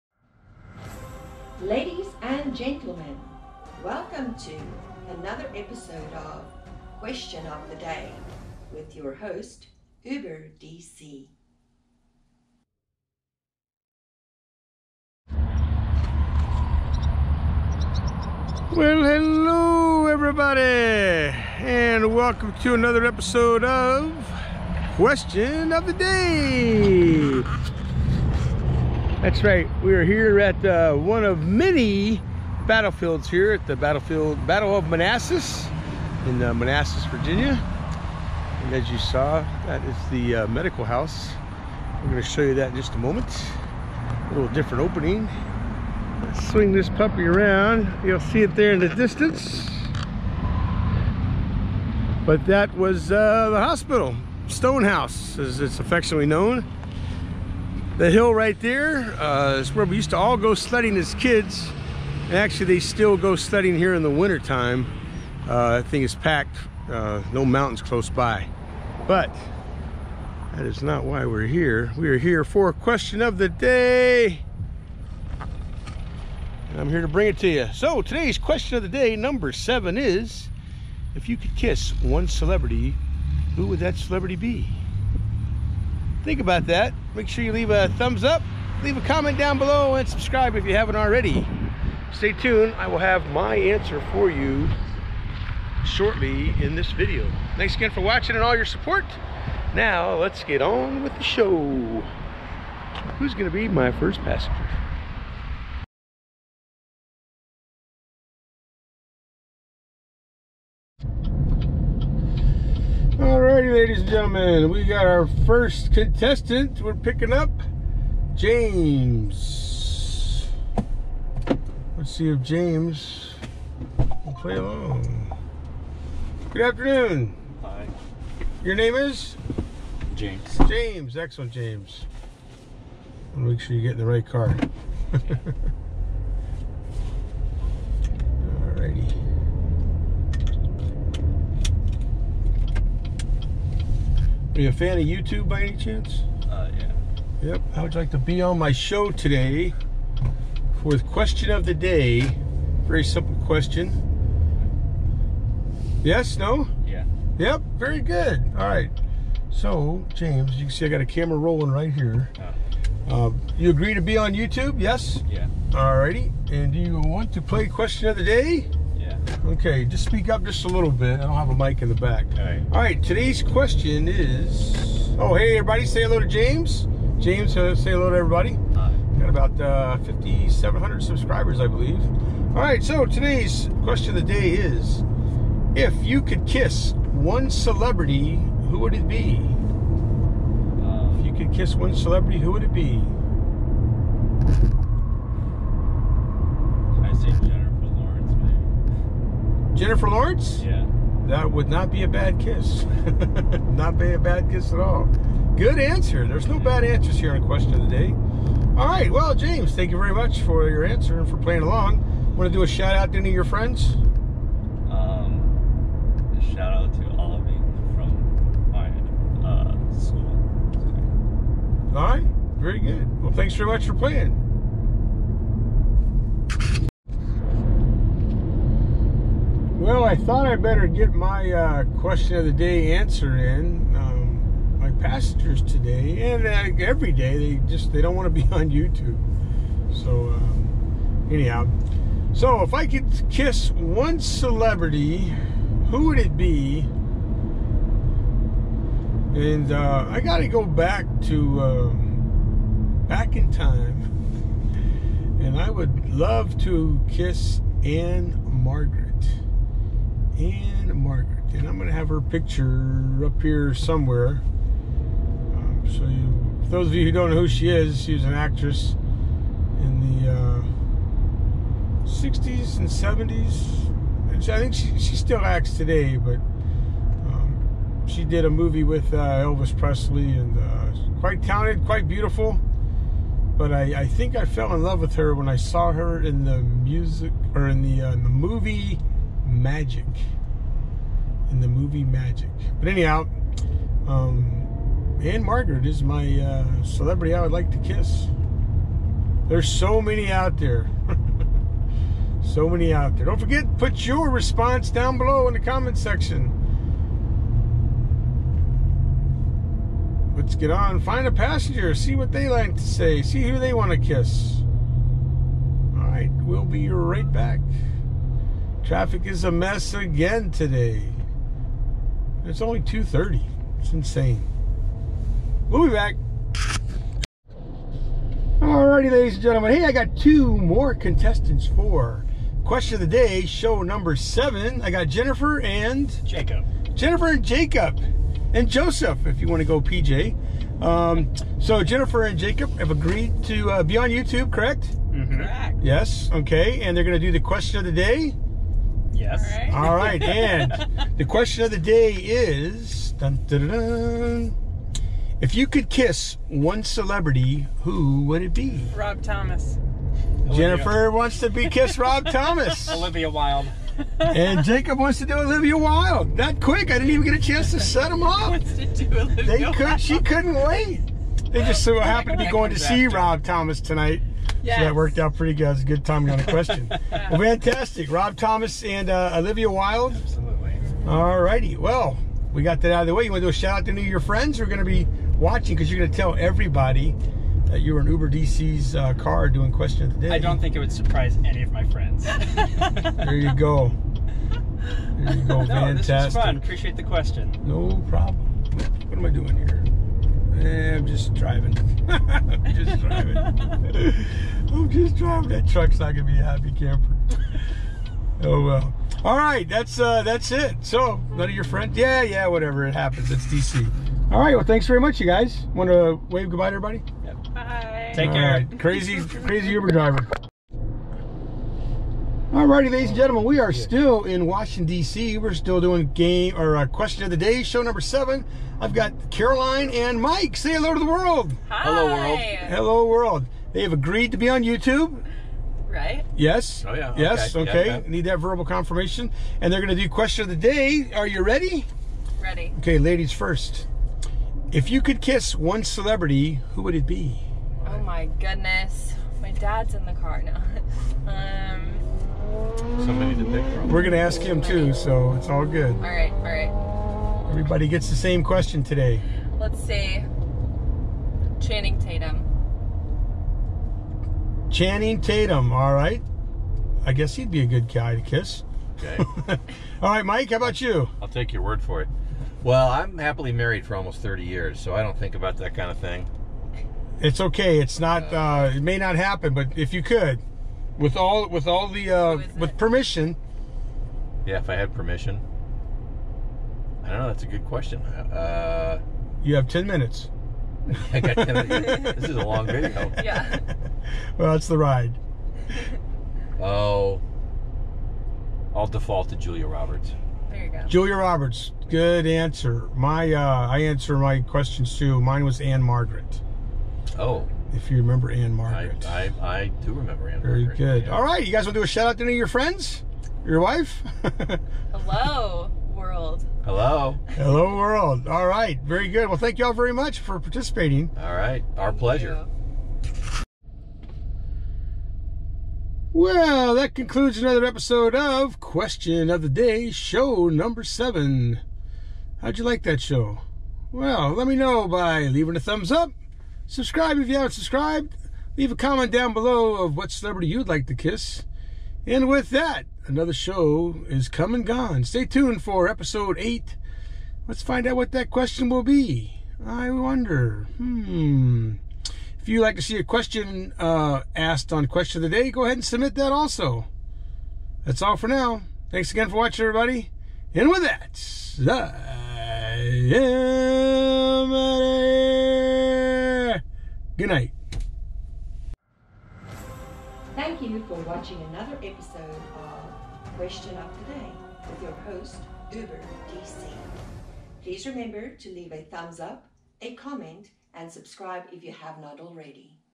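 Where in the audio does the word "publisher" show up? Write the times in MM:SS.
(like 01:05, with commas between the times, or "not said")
not said.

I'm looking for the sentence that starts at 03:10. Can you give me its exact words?
Um, if you could kiss one celebrity, who would it be?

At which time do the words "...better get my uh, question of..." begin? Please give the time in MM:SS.
03:50.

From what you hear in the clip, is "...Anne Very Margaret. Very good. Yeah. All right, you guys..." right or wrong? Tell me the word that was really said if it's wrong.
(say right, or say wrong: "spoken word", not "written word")
right.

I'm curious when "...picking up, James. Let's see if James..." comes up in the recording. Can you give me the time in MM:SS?
01:56.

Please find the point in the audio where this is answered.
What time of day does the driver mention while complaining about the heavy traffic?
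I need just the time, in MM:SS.
05:22.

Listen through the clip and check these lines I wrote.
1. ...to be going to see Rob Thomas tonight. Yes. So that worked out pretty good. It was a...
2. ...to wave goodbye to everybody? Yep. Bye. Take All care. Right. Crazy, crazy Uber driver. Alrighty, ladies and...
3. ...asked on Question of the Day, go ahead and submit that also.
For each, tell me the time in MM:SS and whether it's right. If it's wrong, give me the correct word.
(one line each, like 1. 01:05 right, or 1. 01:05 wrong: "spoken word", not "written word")
1. 06:12 right
2. 06:55 right
3. 09:14 right.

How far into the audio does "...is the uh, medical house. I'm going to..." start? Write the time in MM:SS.
00:39.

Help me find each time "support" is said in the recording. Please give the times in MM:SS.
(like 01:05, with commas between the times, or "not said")
01:38.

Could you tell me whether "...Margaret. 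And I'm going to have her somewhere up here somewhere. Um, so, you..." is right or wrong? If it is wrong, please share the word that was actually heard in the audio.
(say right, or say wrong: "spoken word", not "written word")
wrong: "picture", not "somewhere".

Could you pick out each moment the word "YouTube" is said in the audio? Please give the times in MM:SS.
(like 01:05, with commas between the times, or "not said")
02:25, 02:44, 03:58, 05:44, 07:14.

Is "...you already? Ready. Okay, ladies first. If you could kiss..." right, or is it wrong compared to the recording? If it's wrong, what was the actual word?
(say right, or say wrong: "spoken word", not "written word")
wrong: "ready", not "already".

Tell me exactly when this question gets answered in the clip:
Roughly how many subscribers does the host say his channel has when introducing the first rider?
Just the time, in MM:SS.
03:00.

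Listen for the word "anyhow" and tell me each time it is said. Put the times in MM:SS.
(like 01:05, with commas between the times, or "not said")
04:01, 04:52.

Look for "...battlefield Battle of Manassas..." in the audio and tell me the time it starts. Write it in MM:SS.
00:33.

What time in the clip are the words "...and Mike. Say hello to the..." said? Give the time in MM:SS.
07:09.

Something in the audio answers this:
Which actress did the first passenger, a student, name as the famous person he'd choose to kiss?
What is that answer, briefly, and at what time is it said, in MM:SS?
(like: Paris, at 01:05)
Jennifer Lawrence, at 03:19.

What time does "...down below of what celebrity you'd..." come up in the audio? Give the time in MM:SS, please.
08:59.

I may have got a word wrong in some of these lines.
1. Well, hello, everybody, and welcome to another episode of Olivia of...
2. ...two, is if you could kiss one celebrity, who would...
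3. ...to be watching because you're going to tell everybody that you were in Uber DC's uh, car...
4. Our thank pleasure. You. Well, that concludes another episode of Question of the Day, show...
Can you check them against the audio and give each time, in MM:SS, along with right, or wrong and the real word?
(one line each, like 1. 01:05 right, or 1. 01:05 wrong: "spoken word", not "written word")
1. 00:18 wrong: "Question", not "Olivia"
2. 01:19 wrong: "seven", not "two"
3. 06:24 right
4. 08:41 right.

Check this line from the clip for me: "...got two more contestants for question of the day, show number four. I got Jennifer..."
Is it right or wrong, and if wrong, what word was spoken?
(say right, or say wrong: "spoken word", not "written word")
wrong: "seven", not "four".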